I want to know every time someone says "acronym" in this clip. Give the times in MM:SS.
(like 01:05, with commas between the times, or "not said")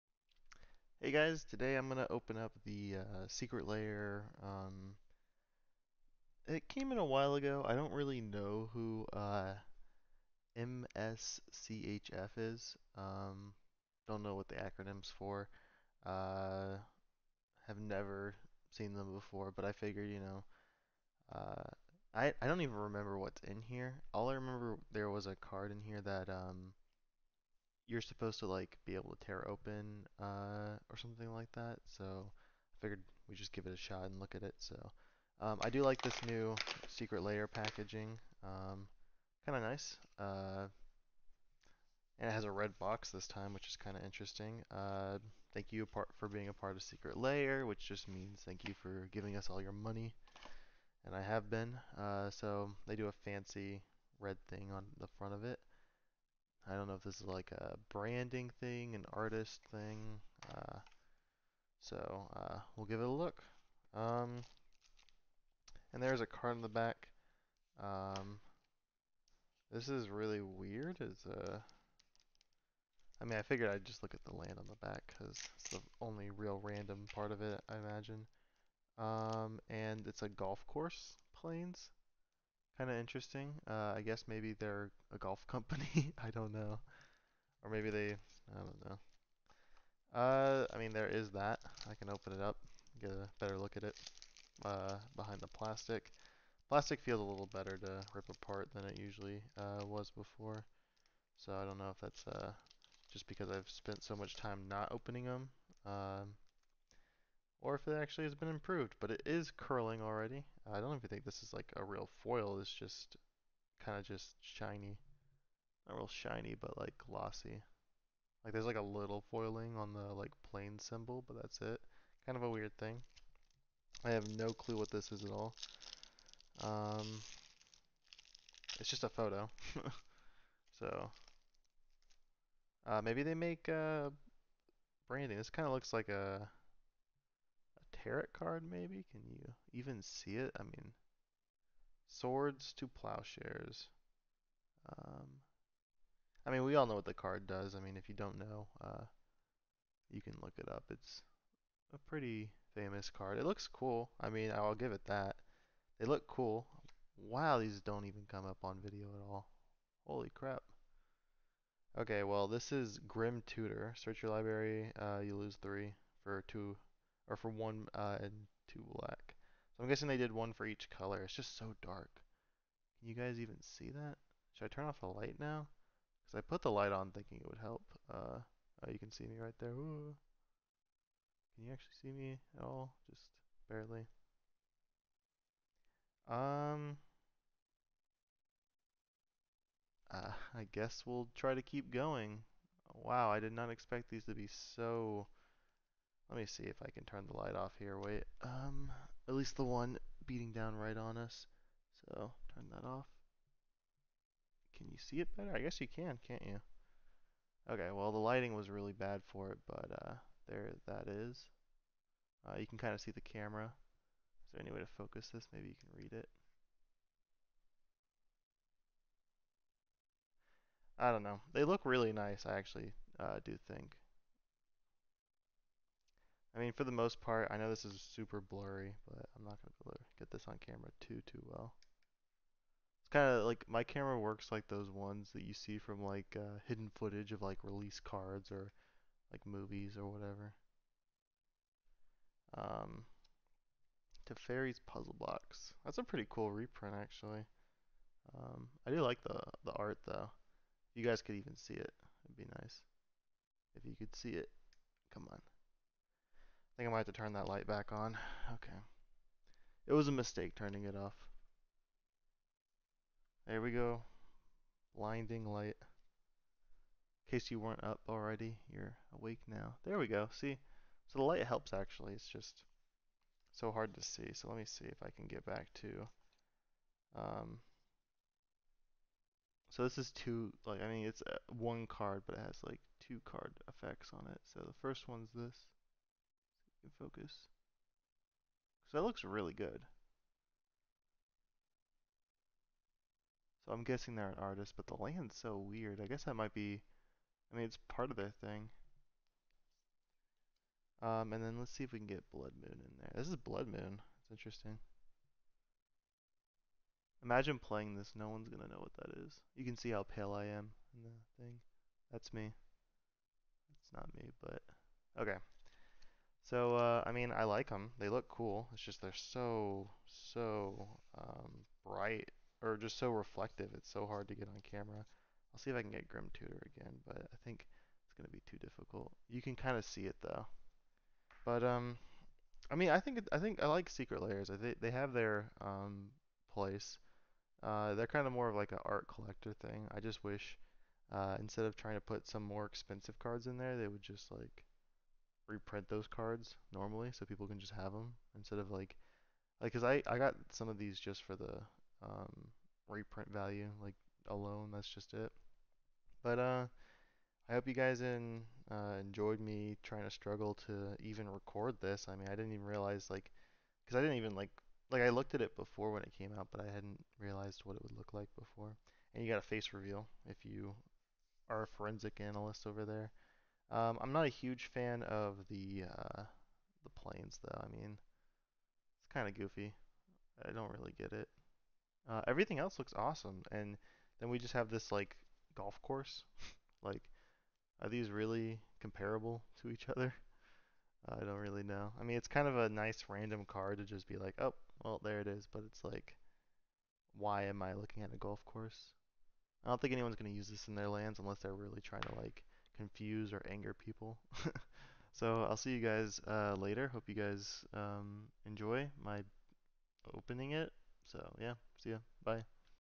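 00:14.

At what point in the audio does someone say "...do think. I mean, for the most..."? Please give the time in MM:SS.
03:43.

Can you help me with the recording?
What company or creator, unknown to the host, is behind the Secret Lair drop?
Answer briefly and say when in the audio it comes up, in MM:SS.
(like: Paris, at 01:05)
MSCHF, at 00:10.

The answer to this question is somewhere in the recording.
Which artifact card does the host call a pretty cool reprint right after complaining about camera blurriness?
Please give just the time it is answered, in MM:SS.
04:04.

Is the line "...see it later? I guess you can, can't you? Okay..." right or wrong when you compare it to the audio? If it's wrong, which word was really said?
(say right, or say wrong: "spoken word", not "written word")
wrong: "better", not "later".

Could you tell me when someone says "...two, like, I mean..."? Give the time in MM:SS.
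04:40.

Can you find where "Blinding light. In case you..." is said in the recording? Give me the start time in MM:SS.
04:24.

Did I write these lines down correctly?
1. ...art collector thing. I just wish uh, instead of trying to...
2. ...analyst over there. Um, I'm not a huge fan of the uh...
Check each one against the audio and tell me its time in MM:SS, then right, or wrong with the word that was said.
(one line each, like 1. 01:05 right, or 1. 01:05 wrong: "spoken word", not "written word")
1. 05:38 right
2. 06:12 right.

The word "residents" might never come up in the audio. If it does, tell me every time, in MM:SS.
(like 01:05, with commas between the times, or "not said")
not said.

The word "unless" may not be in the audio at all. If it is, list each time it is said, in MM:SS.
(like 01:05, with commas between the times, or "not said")
06:41.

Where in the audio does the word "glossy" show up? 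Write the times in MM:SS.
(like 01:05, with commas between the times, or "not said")
01:56.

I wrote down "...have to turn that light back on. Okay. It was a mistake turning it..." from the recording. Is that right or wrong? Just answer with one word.
right.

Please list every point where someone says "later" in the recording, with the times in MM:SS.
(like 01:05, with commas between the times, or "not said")
06:46.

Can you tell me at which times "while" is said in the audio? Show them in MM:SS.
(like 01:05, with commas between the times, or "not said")
00:07.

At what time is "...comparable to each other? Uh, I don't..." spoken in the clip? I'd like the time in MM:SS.
06:28.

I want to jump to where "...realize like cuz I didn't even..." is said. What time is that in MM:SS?
06:02.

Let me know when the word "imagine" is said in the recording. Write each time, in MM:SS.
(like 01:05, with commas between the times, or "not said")
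01:17, 05:07.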